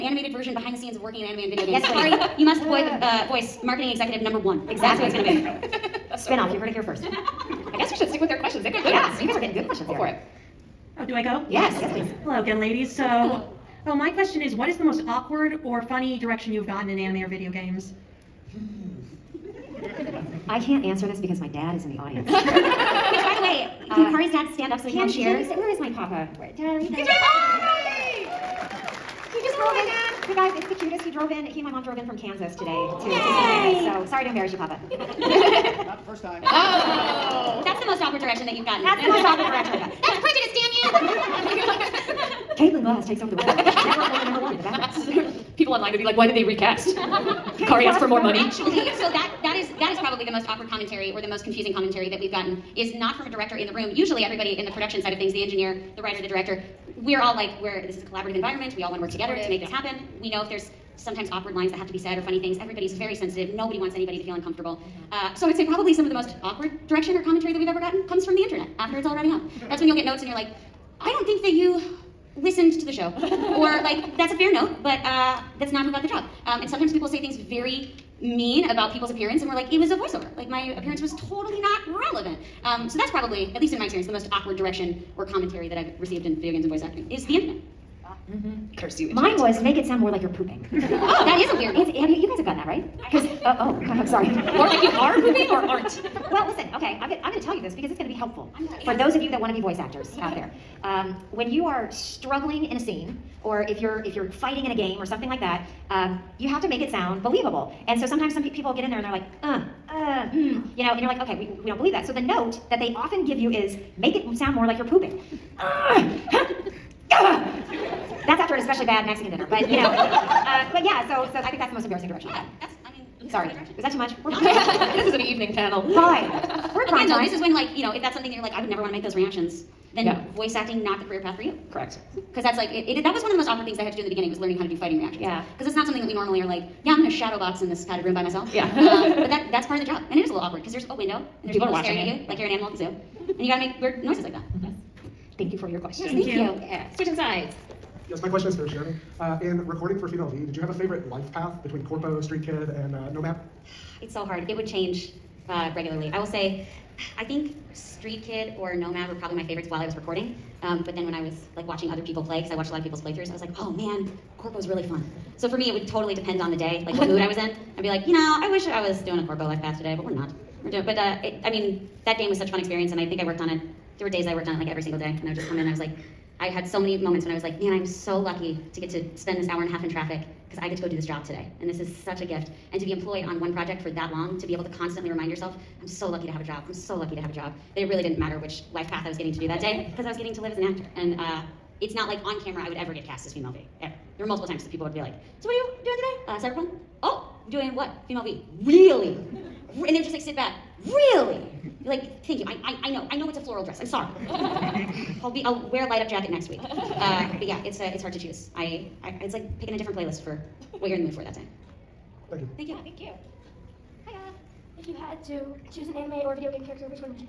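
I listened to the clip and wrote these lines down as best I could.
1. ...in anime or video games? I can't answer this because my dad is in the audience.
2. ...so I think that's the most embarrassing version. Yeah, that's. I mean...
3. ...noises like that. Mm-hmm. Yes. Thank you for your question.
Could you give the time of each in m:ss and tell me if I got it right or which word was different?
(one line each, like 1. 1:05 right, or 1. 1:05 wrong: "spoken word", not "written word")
1. 0:16 right
2. 2:01 wrong: "direction", not "version"
3. 2:24 right.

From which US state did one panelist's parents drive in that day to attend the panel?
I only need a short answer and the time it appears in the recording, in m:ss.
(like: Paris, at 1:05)
Kansas, at 0:32.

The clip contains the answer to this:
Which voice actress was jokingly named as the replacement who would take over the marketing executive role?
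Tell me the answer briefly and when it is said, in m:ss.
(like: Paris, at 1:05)
Caitlin Glass, at 0:42.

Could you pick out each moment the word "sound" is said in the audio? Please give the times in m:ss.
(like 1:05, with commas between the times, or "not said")
1:29, 1:46, 1:54.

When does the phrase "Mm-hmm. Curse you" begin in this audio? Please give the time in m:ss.
1:28.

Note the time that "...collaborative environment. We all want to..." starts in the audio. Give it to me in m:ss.
0:58.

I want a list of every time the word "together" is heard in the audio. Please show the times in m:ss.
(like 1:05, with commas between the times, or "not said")
0:59.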